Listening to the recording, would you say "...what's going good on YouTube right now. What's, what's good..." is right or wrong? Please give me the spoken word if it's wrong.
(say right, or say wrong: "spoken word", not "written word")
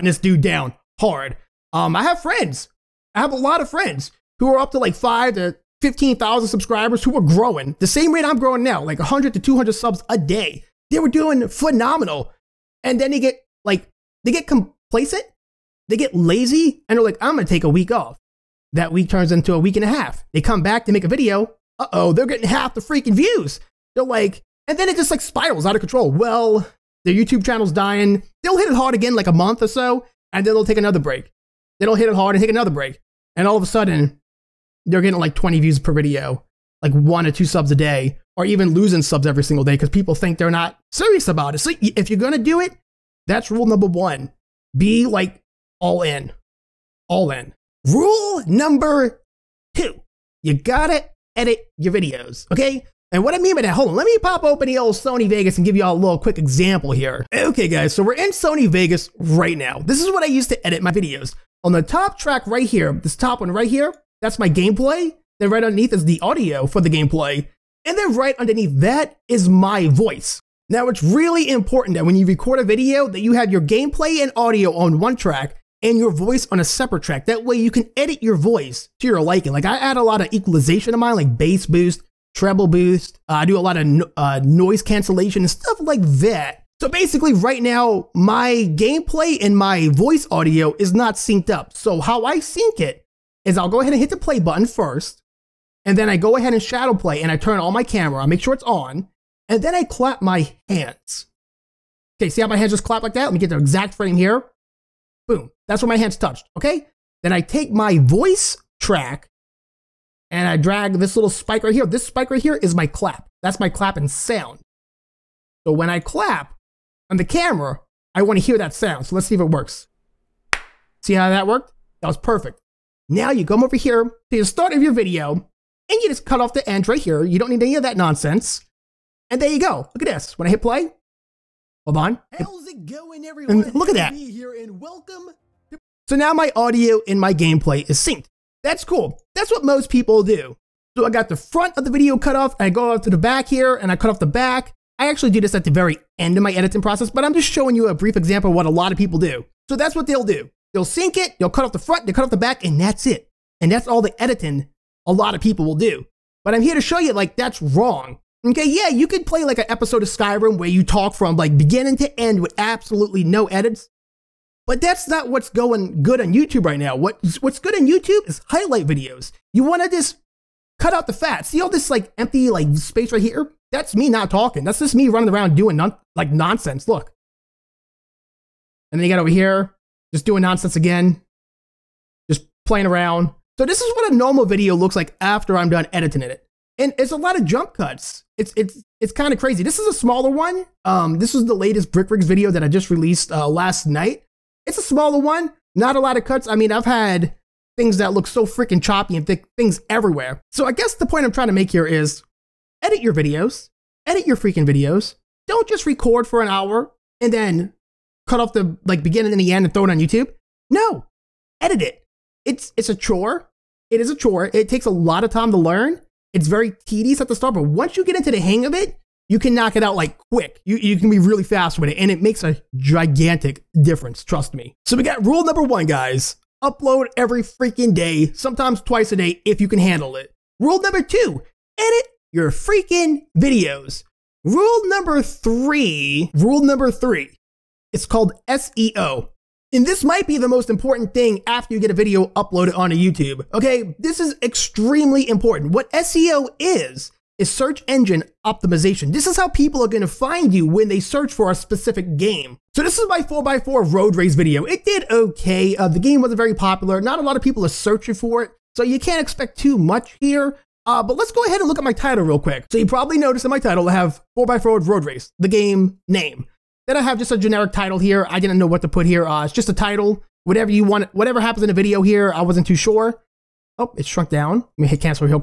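right.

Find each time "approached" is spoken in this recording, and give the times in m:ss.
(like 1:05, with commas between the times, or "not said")
not said.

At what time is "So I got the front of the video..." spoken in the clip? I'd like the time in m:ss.
2:20.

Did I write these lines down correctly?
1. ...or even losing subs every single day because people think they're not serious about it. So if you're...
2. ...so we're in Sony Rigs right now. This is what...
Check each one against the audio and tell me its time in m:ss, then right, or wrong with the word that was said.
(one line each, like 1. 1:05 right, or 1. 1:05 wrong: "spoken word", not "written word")
1. 0:38 right
2. 0:57 wrong: "Vegas", not "Rigs".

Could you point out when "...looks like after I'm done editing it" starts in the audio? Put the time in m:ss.
3:04.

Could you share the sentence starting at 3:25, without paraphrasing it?
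Don't just record for an hour and then cut off the like beginning and the end and throw it on YouTube?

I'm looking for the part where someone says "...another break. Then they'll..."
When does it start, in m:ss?
0:30.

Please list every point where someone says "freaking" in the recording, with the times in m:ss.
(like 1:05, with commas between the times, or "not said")
0:22, 3:18, 3:24, 3:47, 3:52.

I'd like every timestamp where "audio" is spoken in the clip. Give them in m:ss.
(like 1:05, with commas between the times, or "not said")
1:06, 1:14, 1:30, 2:16.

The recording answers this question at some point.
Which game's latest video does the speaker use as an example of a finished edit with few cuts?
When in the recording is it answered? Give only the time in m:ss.
3:11.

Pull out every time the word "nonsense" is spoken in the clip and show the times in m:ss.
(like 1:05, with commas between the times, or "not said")
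2:07, 2:56, 3:00.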